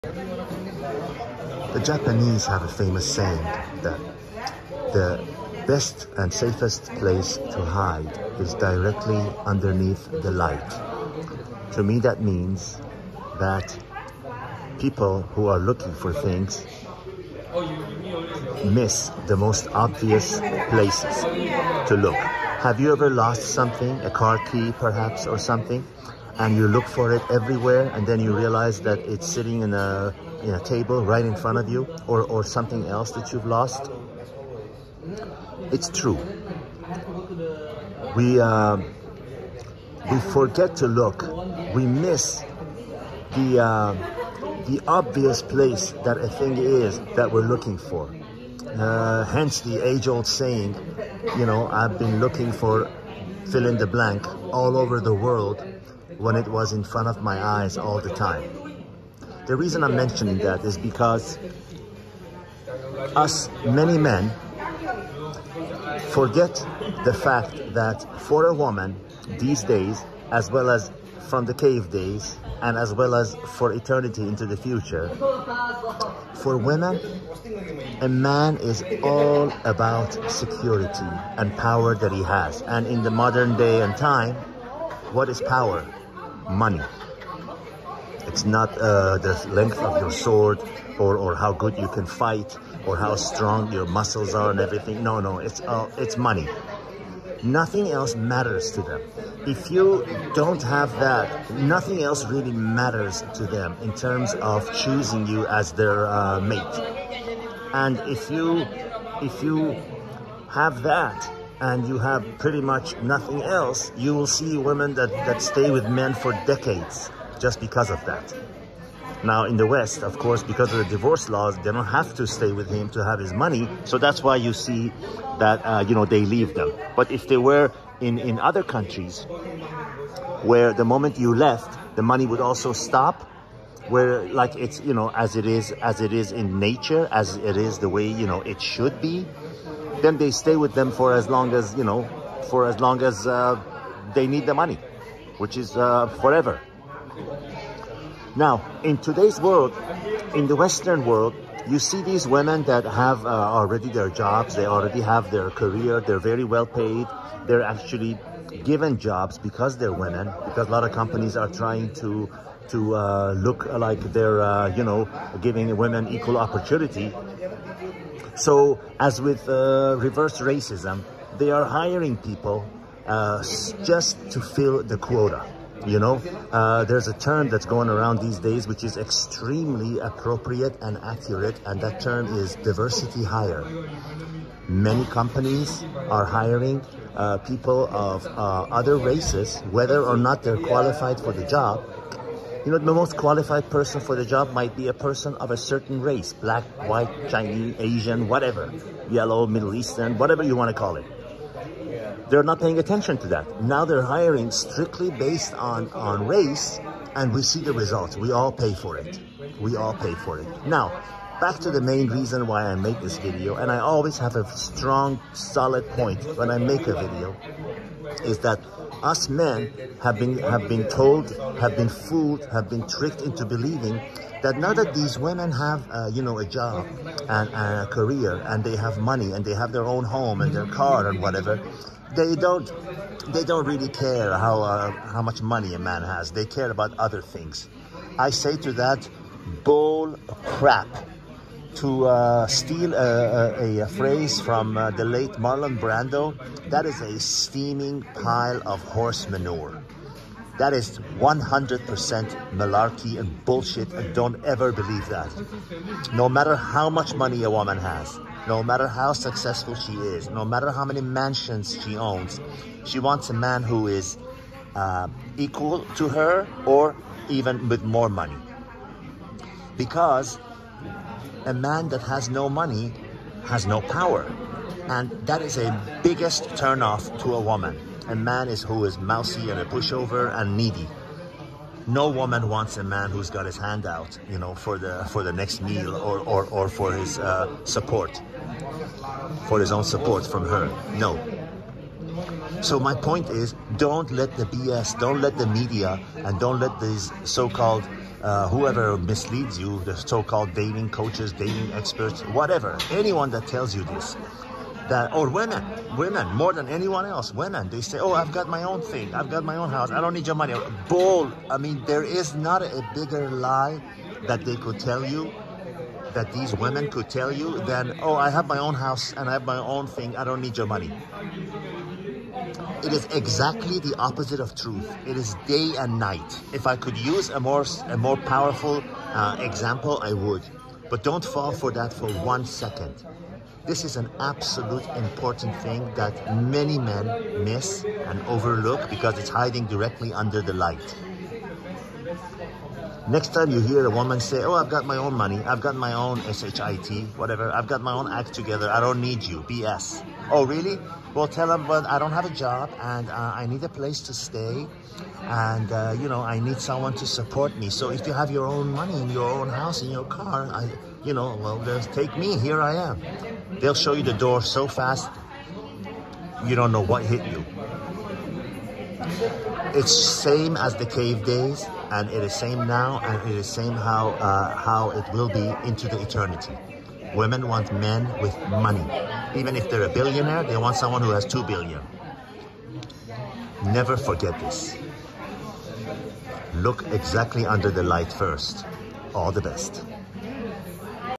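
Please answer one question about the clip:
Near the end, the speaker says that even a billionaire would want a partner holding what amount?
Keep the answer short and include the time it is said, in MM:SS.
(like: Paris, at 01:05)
two billion, at 06:21.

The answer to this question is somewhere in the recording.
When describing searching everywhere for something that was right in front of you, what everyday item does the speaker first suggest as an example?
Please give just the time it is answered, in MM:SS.
00:24.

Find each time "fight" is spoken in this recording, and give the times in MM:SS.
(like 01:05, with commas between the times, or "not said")
01:32.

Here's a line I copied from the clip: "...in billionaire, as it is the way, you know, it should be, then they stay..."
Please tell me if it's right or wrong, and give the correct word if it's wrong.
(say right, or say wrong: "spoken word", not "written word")
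wrong: "nature", not "billionaire".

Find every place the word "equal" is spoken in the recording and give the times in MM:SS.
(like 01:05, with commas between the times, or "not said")
02:46, 04:25.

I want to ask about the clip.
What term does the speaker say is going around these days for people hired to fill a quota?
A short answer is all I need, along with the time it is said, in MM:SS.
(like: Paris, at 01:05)
diversity hire, at 03:02.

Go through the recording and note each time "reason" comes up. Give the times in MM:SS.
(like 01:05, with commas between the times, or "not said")
00:59, 03:32.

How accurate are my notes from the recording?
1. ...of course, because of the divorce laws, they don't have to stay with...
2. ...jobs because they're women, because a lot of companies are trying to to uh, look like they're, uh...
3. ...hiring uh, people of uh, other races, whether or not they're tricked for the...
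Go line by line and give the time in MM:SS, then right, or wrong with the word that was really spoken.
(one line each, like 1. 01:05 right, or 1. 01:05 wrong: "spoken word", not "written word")
1. 02:00 right
2. 02:38 right
3. 03:06 wrong: "qualified", not "tricked".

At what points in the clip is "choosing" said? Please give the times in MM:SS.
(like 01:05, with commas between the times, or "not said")
01:44.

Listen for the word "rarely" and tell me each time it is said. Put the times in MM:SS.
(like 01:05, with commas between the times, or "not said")
not said.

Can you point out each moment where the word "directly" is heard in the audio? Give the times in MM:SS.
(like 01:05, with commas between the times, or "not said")
00:08, 05:39.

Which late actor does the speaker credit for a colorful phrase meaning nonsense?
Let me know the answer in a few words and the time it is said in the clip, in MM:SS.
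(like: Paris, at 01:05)
Marlon Brando, at 04:05.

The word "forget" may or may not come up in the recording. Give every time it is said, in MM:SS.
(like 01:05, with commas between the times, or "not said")
00:40, 01:06, 06:23.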